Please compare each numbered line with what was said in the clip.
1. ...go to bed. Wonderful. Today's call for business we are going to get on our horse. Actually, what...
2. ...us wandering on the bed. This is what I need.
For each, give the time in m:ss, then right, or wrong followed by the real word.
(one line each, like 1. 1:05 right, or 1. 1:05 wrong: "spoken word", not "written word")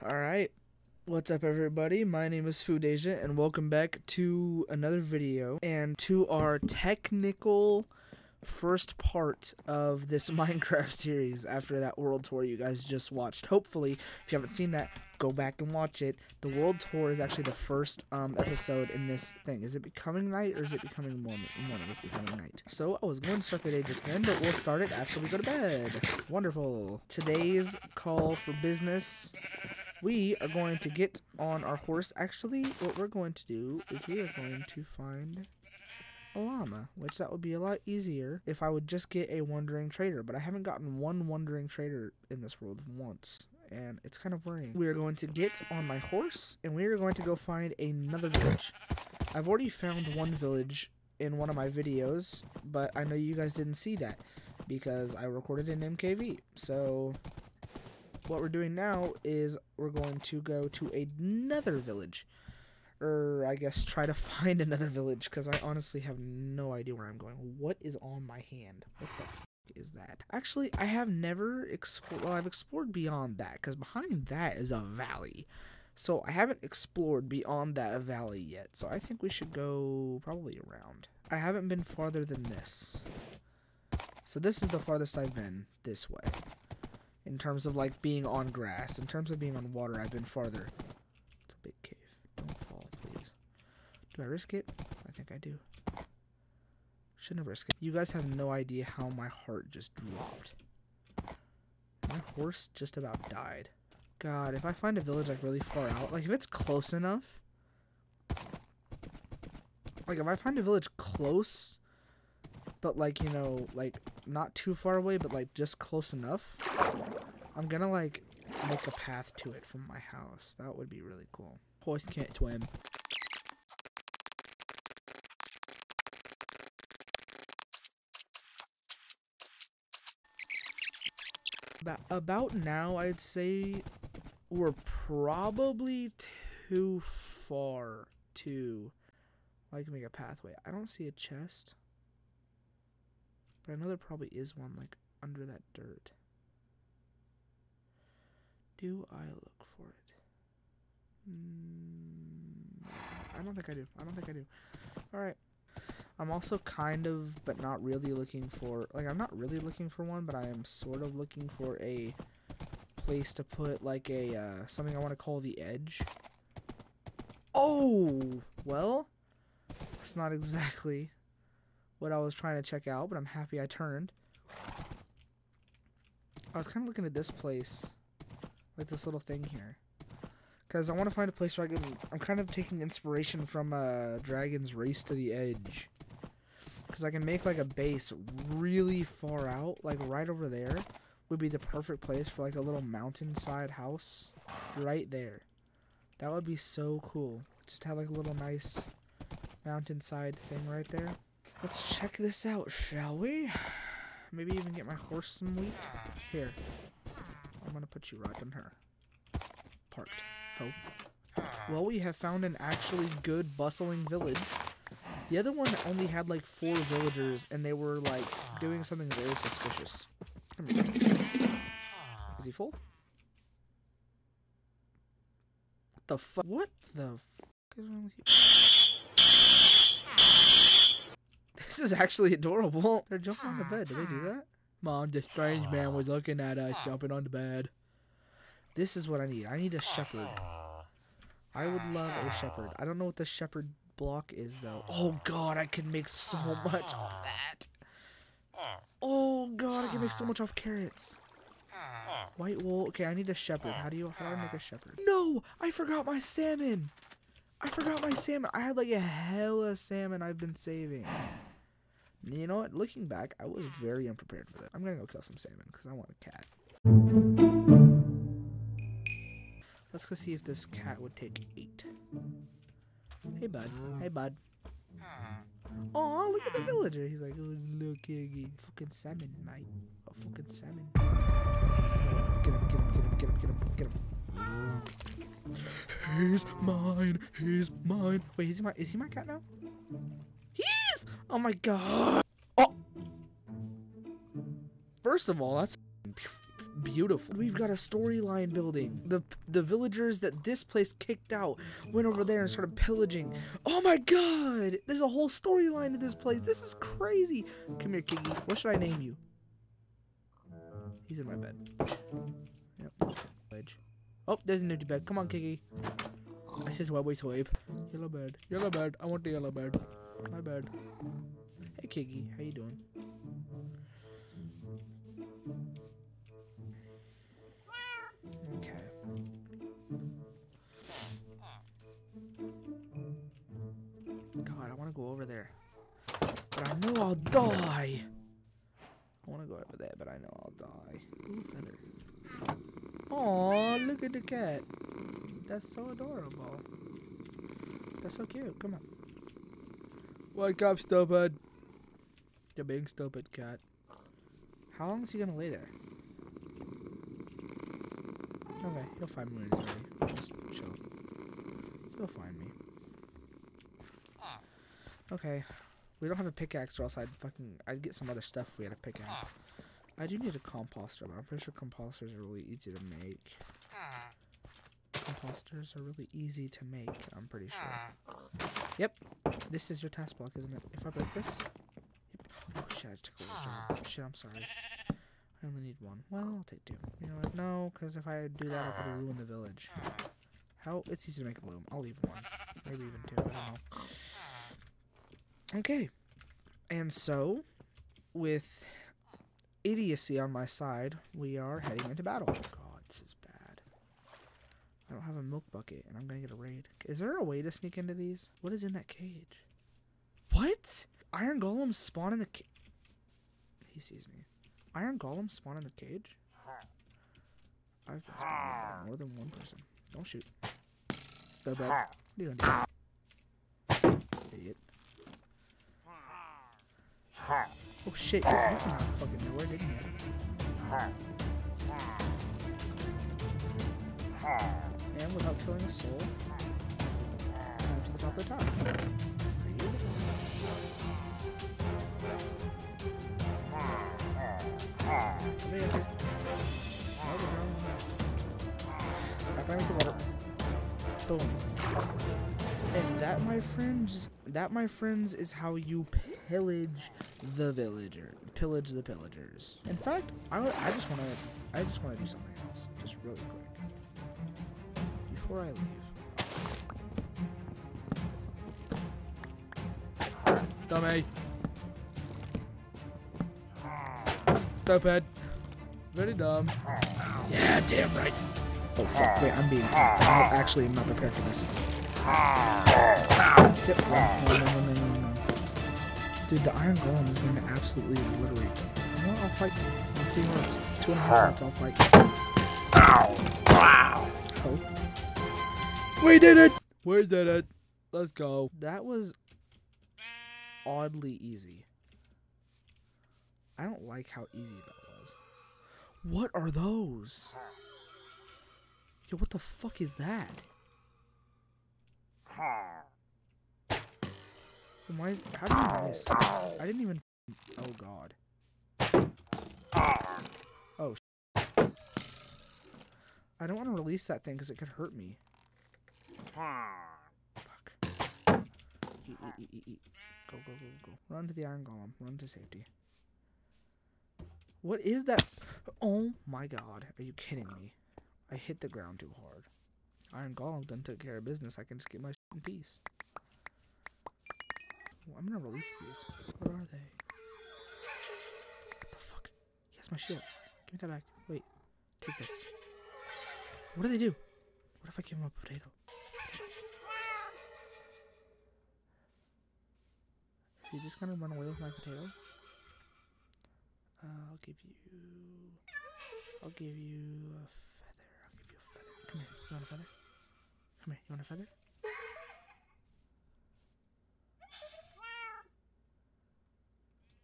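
1. 0:25 right
2. 3:56 wrong: "jumping", not "wandering".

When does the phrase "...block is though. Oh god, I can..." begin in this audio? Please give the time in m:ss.
4:03.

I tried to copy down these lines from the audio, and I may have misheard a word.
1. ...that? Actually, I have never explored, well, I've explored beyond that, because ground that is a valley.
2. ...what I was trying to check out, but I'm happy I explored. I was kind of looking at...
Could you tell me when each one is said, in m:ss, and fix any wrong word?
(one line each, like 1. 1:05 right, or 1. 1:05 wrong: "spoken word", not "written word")
1. 1:09 wrong: "behind", not "ground"
2. 2:52 wrong: "turned", not "explored".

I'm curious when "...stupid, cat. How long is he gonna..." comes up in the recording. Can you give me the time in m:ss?
5:52.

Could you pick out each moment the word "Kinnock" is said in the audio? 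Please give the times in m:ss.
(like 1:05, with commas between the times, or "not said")
not said.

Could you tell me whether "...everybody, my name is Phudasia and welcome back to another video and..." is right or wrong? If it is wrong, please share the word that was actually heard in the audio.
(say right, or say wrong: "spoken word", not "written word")
right.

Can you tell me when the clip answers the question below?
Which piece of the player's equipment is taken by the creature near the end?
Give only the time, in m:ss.
9:09.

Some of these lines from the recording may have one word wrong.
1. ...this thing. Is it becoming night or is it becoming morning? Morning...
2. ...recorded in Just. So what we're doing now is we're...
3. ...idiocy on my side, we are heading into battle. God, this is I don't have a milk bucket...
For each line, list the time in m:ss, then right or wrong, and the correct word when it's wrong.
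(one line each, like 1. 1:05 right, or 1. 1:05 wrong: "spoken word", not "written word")
1. 0:19 right
2. 0:55 wrong: "MKV", not "Just"
3. 6:39 right.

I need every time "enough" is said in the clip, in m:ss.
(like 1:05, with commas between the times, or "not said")
1:46, 1:56.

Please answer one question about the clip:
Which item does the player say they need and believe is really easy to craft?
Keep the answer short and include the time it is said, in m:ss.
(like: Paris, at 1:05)
composter, at 6:10.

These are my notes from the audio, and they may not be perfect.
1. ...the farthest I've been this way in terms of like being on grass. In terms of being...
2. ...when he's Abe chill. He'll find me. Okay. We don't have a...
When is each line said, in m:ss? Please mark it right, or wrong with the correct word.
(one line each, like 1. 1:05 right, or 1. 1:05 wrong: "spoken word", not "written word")
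1. 1:24 right
2. 5:59 wrong: "Just", not "Abe".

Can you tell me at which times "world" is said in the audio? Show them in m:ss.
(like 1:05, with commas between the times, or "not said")
0:11, 0:16, 0:42.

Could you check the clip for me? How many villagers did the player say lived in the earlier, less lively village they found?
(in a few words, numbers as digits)
4.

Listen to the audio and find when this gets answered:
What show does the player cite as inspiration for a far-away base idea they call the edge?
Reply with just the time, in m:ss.
3:04.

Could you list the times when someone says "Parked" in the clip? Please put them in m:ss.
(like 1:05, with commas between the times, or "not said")
3:29.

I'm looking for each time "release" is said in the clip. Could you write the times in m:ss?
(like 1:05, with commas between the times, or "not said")
8:43, 9:05.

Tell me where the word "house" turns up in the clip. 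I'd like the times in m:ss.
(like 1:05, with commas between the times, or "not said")
1:59, 3:13.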